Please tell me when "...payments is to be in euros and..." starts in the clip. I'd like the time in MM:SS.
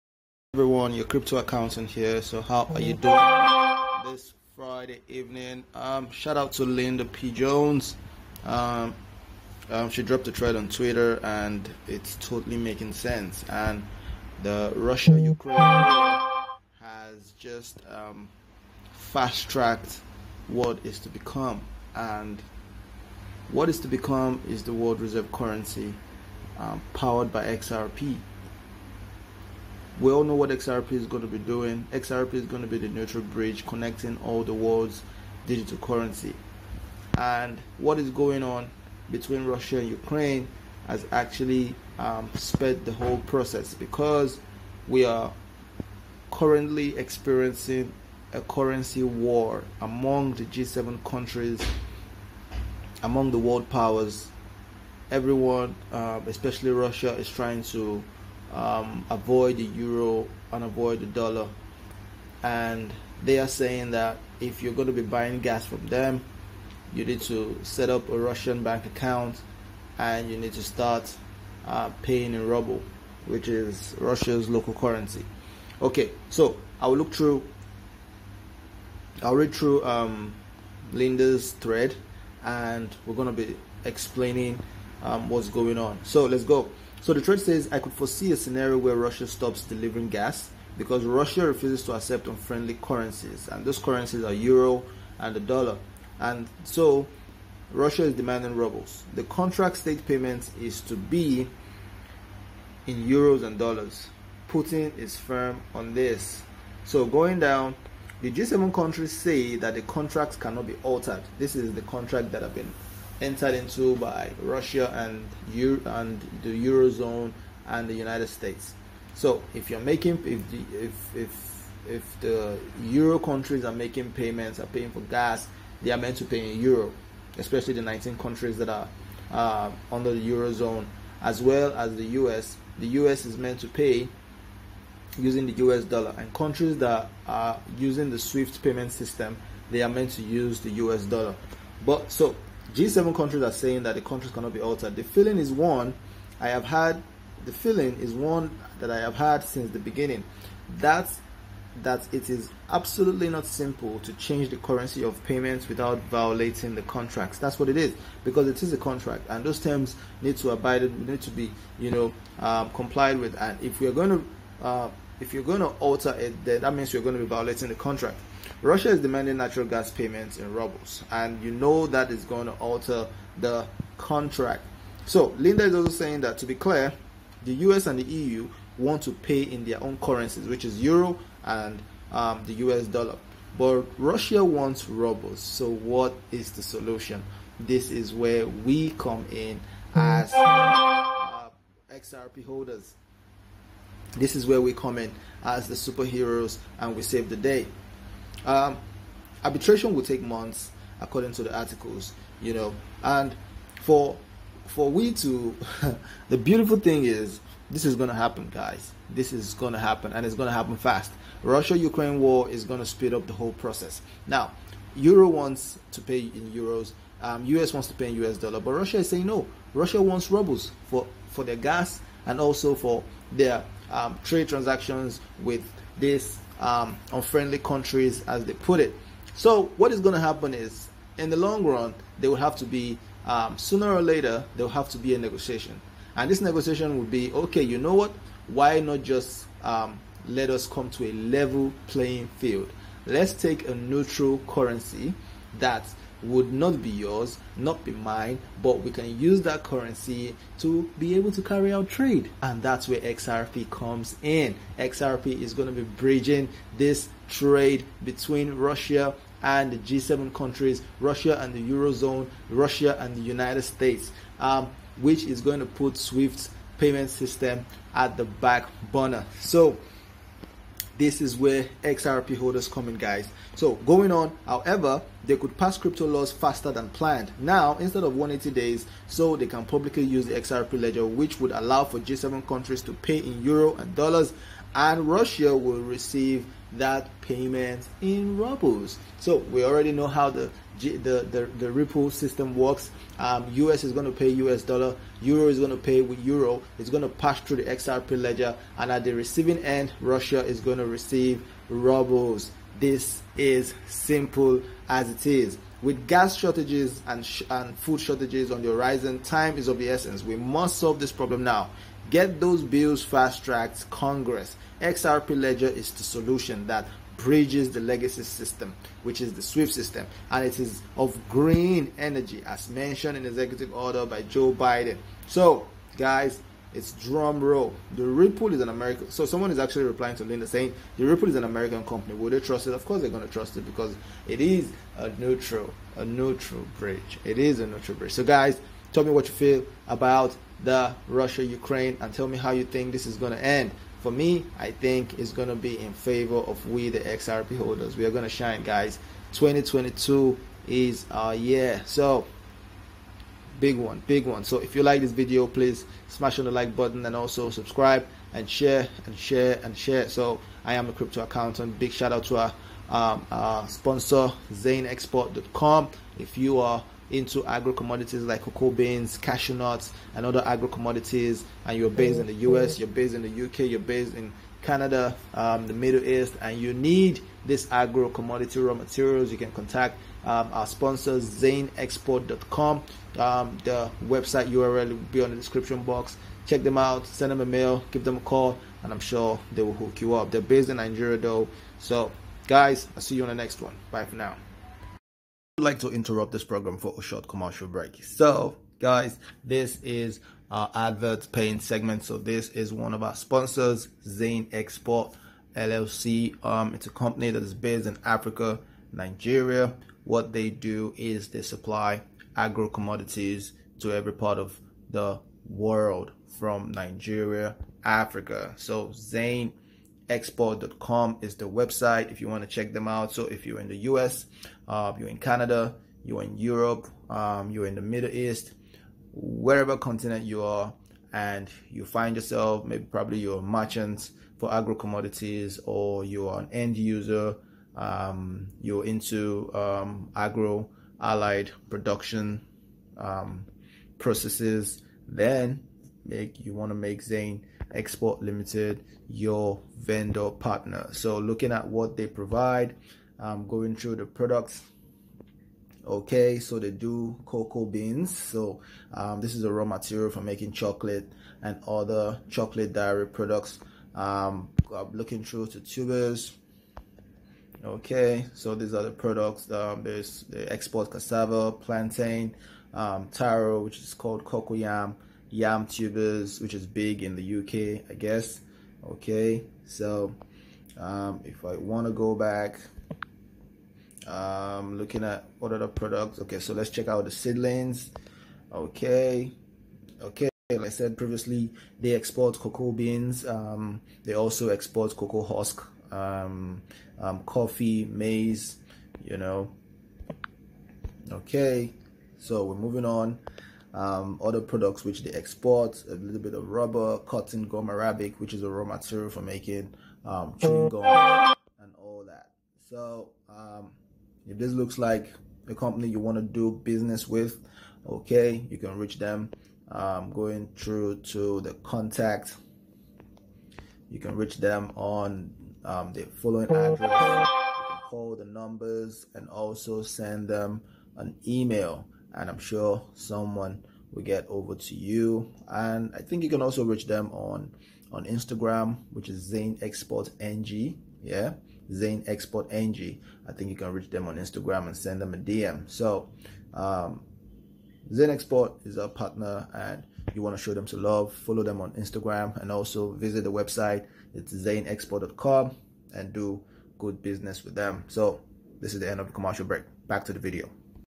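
01:40.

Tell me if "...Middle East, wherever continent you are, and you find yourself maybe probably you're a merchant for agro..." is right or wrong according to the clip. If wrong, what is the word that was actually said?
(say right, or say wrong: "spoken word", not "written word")
right.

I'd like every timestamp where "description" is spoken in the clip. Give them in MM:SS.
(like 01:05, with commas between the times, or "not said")
06:25.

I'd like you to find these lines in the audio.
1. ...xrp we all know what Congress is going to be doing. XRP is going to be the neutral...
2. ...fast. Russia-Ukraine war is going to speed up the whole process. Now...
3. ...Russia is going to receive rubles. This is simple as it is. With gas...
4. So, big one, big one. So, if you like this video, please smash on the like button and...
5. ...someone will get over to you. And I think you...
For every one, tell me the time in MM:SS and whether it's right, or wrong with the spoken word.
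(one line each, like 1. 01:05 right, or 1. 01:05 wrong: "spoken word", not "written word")
1. 00:27 wrong: "XRP", not "Congress"
2. 03:30 right
3. 05:00 right
4. 05:51 right
5. 08:52 right.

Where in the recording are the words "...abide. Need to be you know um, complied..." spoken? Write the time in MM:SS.
02:40.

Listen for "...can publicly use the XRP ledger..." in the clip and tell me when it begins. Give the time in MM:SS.
04:39.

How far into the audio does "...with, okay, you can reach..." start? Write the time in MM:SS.
08:37.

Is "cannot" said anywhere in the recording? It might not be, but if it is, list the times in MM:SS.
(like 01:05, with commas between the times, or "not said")
01:50, 02:24.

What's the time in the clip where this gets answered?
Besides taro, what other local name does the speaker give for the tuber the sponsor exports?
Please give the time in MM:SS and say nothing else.
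07:54.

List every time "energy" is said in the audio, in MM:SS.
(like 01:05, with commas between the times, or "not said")
05:21.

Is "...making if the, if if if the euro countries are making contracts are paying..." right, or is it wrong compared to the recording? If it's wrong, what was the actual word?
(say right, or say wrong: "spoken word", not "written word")
wrong: "payments", not "contracts".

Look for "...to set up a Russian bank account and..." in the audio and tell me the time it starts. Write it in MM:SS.
01:07.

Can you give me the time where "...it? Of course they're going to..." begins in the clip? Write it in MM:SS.
05:32.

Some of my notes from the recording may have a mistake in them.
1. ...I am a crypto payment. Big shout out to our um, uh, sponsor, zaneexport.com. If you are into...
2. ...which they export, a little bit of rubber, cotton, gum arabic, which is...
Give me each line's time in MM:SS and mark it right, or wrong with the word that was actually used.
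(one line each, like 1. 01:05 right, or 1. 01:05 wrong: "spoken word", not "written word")
1. 06:00 wrong: "accountant", not "payment"
2. 08:24 right.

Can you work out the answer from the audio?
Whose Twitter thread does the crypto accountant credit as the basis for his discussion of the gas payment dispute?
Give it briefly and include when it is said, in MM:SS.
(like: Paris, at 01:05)
Linda P Jones, at 00:06.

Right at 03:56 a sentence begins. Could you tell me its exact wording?
And this negotiation will be okay, you know what?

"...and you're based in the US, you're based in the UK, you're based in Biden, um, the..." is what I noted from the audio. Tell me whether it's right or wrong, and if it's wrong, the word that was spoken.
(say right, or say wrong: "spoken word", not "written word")
wrong: "Canada", not "Biden".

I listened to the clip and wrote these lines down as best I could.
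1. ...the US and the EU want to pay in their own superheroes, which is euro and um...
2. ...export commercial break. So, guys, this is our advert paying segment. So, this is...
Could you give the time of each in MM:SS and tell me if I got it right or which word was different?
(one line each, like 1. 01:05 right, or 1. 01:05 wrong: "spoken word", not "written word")
1. 02:57 wrong: "currencies", not "superheroes"
2. 06:37 wrong: "short", not "export".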